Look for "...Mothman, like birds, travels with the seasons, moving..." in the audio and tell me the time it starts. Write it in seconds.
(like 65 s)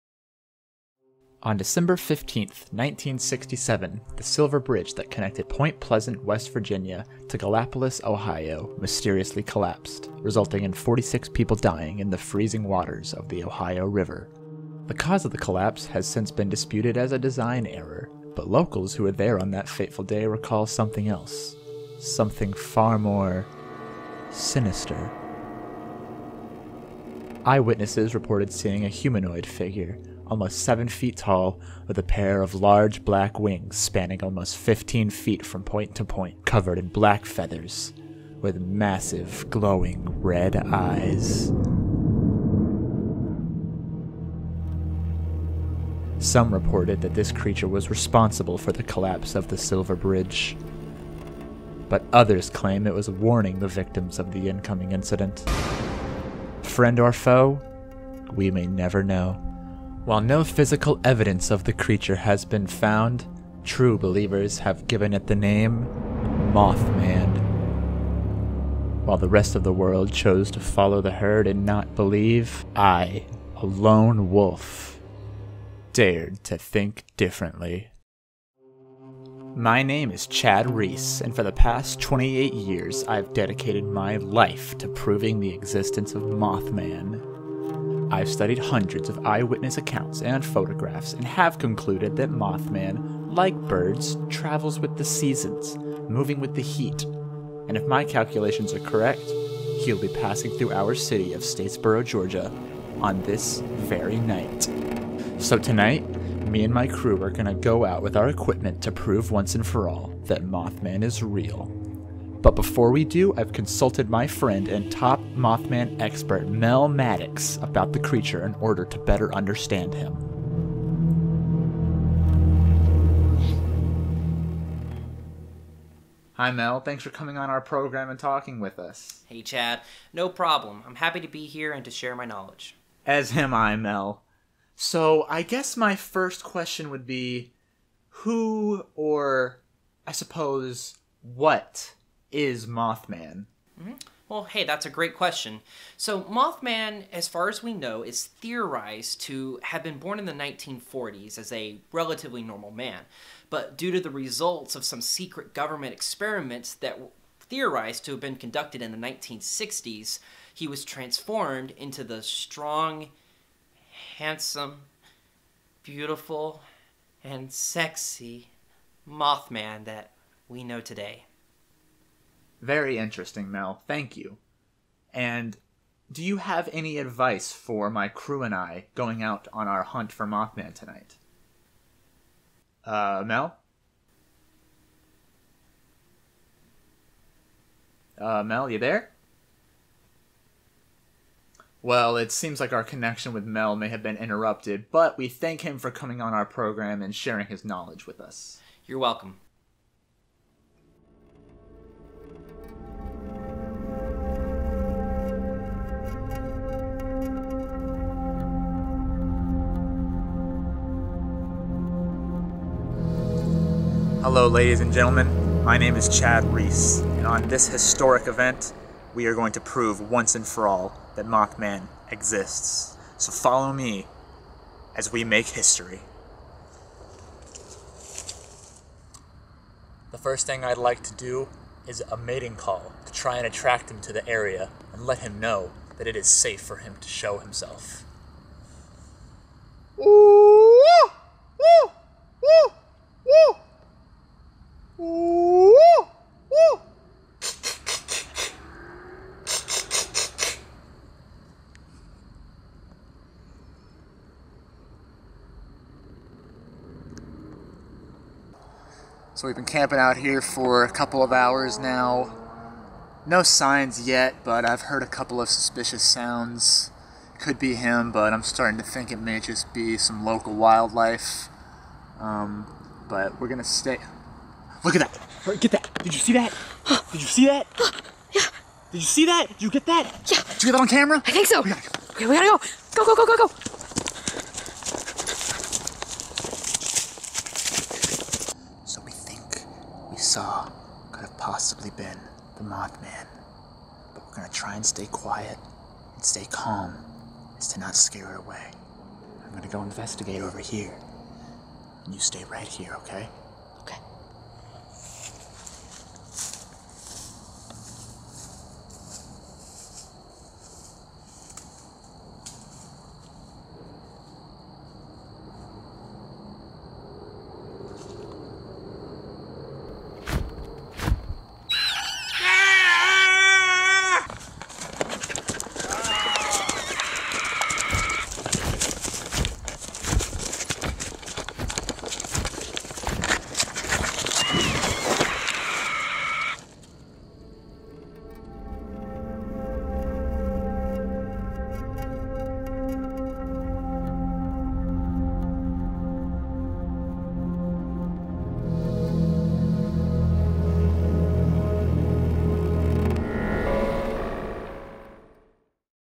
92 s.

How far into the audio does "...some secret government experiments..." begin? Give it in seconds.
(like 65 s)
154 s.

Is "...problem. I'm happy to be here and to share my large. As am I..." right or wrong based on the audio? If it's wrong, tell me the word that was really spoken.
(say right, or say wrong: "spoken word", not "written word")
wrong: "knowledge", not "large".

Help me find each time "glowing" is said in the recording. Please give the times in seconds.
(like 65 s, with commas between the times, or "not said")
39 s.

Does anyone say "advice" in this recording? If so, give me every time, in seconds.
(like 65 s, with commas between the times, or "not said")
176 s.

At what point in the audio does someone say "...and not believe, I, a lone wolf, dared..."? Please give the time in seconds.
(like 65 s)
71 s.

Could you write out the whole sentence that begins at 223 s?
So follow me as we make history.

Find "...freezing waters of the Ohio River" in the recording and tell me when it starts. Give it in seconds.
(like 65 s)
12 s.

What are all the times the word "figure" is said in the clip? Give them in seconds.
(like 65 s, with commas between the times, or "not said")
29 s.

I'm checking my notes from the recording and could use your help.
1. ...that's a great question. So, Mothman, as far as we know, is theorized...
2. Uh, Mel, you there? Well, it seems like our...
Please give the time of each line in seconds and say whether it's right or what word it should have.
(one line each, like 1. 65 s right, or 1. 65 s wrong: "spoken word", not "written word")
1. 144 s right
2. 188 s right.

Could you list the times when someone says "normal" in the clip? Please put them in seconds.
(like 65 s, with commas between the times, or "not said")
152 s.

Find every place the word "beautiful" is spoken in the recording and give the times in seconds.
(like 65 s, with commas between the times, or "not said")
165 s.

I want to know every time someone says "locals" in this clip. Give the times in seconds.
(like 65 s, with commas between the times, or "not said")
18 s, 270 s.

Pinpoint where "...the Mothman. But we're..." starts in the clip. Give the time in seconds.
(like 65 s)
292 s.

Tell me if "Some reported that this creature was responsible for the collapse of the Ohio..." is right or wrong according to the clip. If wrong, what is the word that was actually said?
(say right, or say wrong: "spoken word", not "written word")
wrong: "Silver", not "Ohio".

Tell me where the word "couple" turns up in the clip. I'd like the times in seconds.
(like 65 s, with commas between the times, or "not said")
260 s, 265 s.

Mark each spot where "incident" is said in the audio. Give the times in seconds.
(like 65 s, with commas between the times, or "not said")
54 s.